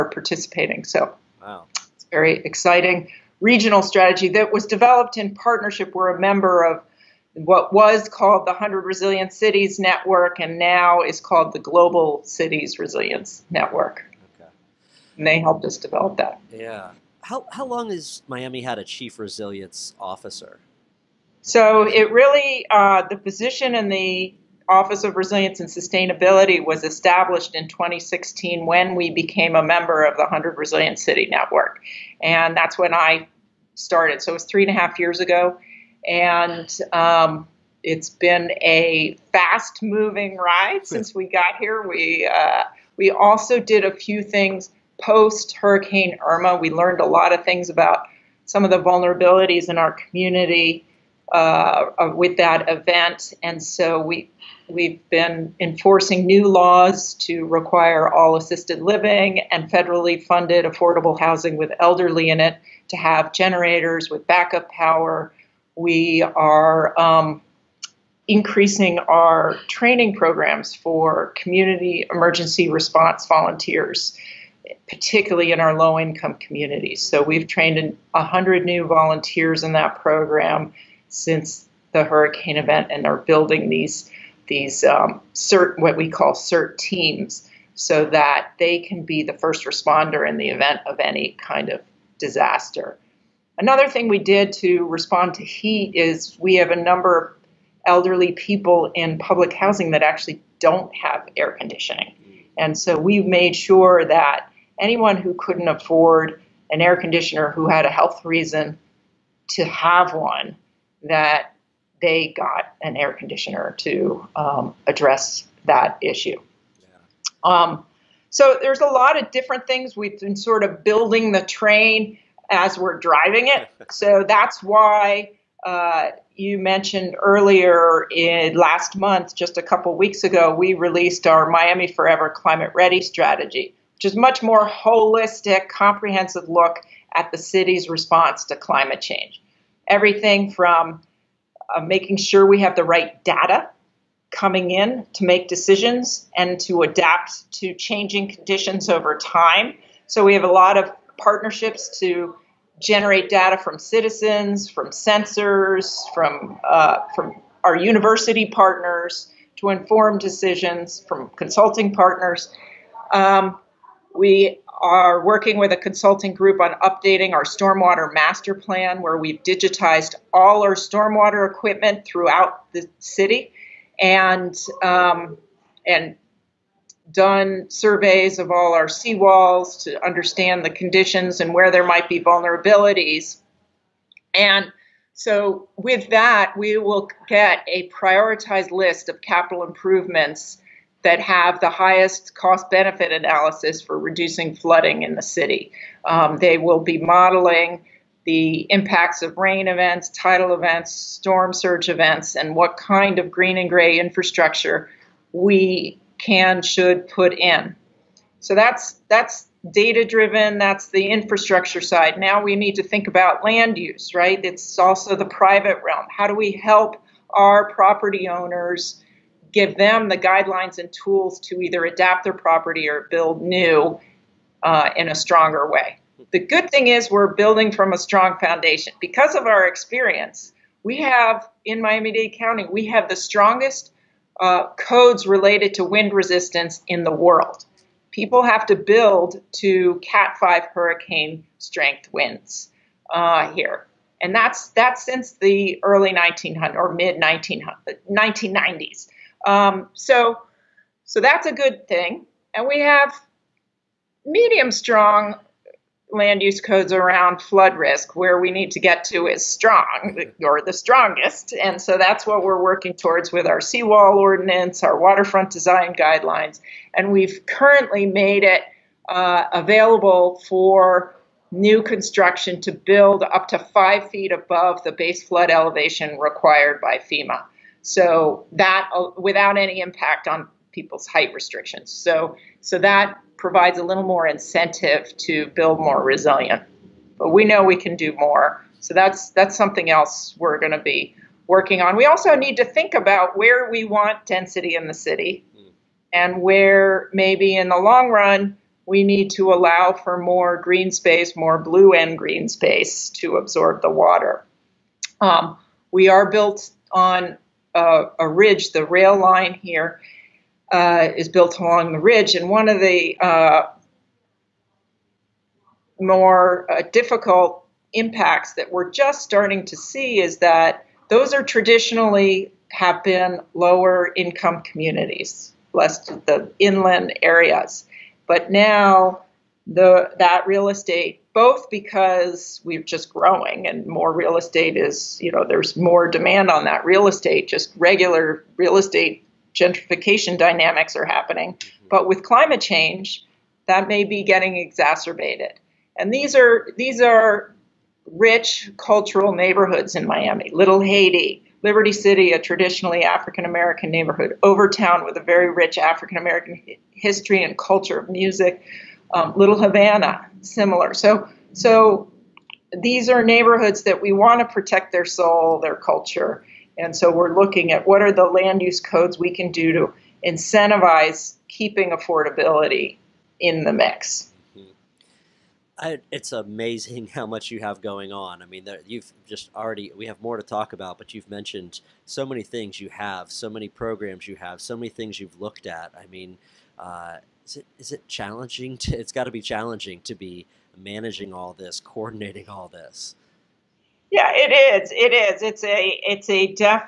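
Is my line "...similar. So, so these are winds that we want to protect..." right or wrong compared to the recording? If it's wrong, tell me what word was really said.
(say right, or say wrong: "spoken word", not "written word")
wrong: "neighborhoods", not "winds".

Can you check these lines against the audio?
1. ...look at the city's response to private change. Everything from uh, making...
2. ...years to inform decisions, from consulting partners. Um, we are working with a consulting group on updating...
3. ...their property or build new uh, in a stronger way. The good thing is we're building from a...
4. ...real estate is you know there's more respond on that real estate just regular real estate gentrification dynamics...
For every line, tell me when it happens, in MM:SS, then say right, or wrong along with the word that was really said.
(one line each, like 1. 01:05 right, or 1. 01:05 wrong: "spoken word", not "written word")
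1. 02:16 wrong: "climate", not "private"
2. 02:38 wrong: "partners", not "years"
3. 03:42 right
4. 05:34 wrong: "demand", not "respond".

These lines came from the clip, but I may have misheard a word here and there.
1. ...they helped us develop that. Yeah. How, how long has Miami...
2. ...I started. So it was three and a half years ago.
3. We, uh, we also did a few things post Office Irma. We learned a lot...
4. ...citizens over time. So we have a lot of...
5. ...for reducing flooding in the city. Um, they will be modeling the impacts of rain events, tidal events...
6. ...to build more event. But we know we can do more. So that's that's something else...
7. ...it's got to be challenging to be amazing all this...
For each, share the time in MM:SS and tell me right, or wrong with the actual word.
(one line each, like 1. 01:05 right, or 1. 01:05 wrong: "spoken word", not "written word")
1. 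00:15 right
2. 00:32 right
3. 00:41 wrong: "Hurricane", not "Office"
4. 02:28 wrong: "conditions", not "citizens"
5. 03:13 right
6. 04:45 wrong: "resilient", not "event"
7. 06:28 wrong: "managing", not "amazing".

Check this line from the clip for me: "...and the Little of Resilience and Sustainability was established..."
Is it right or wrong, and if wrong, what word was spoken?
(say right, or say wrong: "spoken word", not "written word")
wrong: "Office", not "Little".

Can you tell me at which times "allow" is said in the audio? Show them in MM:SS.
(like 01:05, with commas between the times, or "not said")
04:59.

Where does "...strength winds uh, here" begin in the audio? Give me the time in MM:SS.
04:01.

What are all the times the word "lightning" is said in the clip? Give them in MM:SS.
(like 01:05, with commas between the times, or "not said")
not said.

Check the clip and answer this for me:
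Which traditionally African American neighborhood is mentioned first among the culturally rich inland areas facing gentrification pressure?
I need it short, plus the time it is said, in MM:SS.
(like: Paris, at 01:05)
Liberty City, at 05:51.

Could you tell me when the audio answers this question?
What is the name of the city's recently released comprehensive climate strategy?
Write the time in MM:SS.
02:11.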